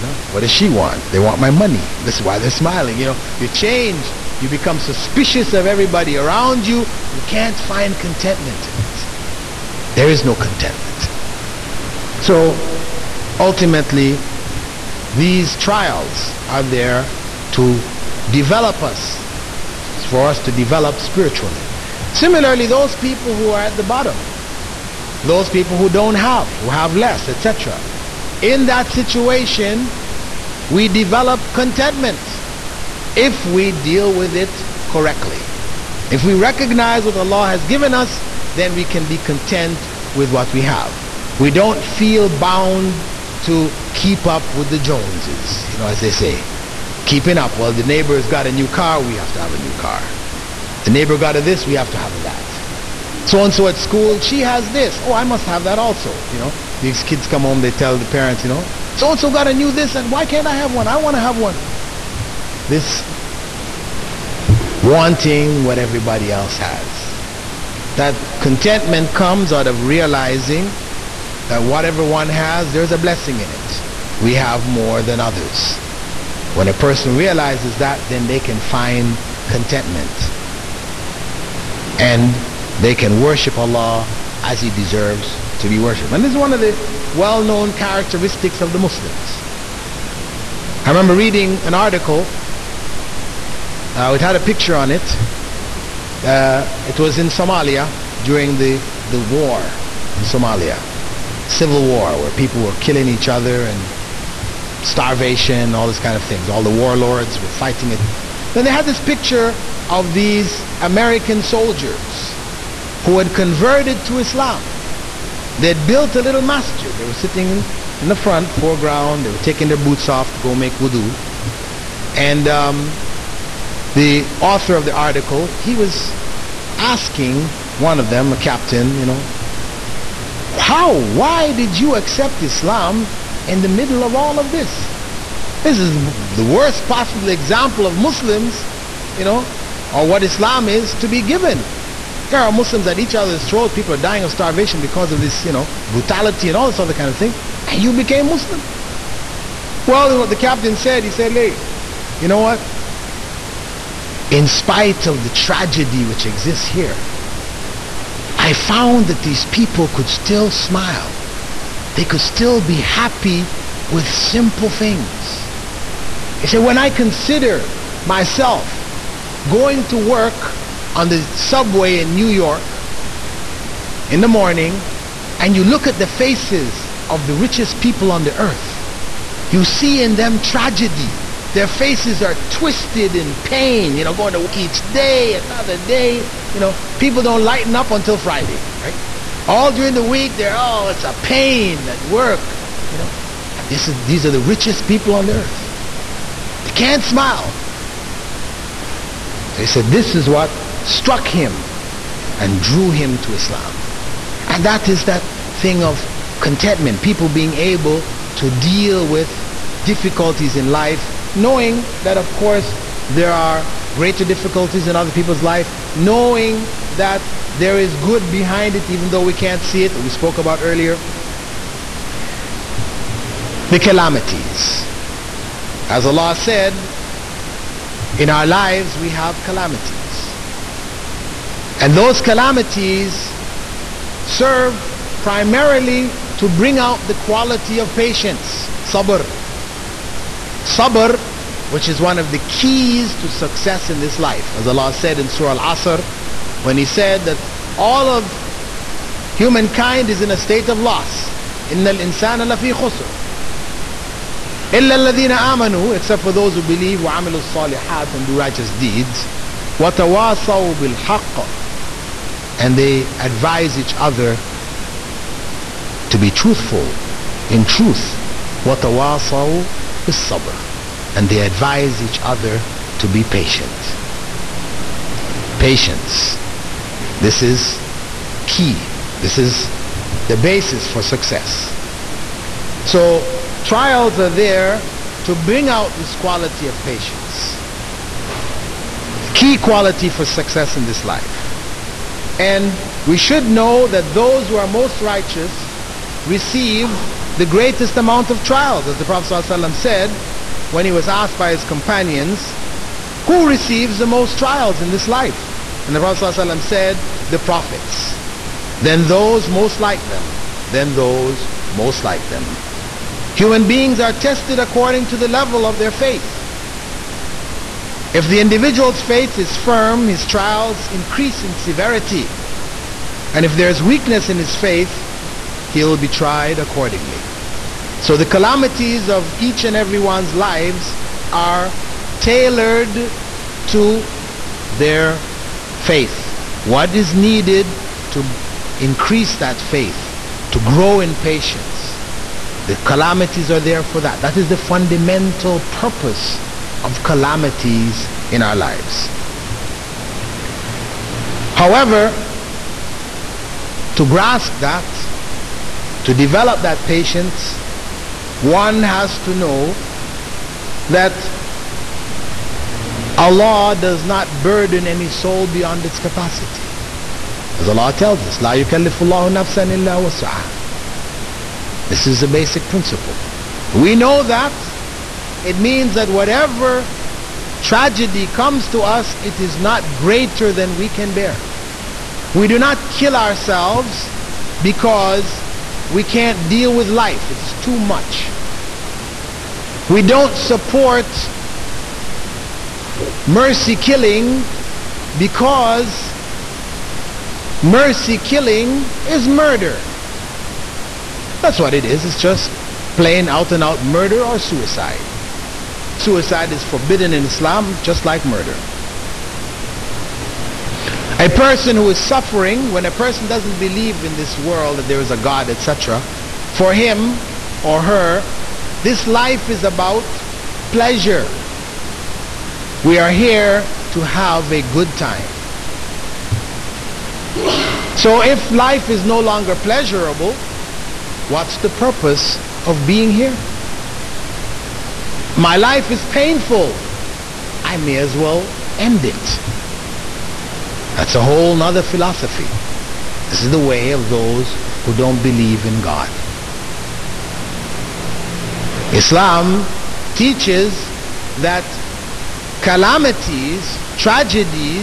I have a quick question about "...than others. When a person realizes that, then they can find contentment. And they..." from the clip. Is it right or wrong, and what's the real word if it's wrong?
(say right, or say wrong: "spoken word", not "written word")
right.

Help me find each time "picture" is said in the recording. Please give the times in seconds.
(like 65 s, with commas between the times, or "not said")
94 s, 109 s.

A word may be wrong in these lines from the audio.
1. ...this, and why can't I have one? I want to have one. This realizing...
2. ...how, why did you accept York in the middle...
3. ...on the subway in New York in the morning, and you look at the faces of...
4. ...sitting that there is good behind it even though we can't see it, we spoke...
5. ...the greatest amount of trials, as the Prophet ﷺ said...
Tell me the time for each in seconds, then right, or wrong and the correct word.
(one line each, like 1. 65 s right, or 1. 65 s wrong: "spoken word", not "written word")
1. 59 s wrong: "wanting", not "realizing"
2. 130 s wrong: "Islam", not "York"
3. 170 s right
4. 215 s wrong: "knowing", not "sitting"
5. 297 s right.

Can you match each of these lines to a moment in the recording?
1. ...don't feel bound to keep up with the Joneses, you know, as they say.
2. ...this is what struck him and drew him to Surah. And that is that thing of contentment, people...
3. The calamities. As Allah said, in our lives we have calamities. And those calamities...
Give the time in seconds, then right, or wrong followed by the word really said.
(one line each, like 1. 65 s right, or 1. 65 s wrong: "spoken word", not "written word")
1. 41 s right
2. 199 s wrong: "Islam", not "Surah"
3. 223 s right.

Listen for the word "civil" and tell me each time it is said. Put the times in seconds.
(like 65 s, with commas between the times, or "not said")
101 s.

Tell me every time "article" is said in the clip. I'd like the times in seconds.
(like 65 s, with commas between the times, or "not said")
91 s, 124 s.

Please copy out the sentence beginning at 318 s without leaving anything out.
If the individual's faith is firm, his trials increase in severity.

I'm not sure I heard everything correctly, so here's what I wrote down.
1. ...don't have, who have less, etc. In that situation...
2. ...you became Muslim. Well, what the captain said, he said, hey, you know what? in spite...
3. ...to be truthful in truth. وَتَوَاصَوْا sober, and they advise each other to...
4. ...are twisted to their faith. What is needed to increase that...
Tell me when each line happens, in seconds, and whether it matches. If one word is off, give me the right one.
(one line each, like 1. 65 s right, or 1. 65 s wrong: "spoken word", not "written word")
1. 25 s right
2. 147 s right
3. 266 s right
4. 331 s wrong: "tailored", not "twisted".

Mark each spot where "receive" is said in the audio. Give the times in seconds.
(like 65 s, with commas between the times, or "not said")
296 s, 303 s.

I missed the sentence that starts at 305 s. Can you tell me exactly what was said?
And the Prophet ﷺ said, The prophets.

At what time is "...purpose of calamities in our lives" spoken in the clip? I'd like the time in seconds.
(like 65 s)
345 s.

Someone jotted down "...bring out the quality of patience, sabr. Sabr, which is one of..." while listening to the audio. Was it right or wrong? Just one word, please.
right.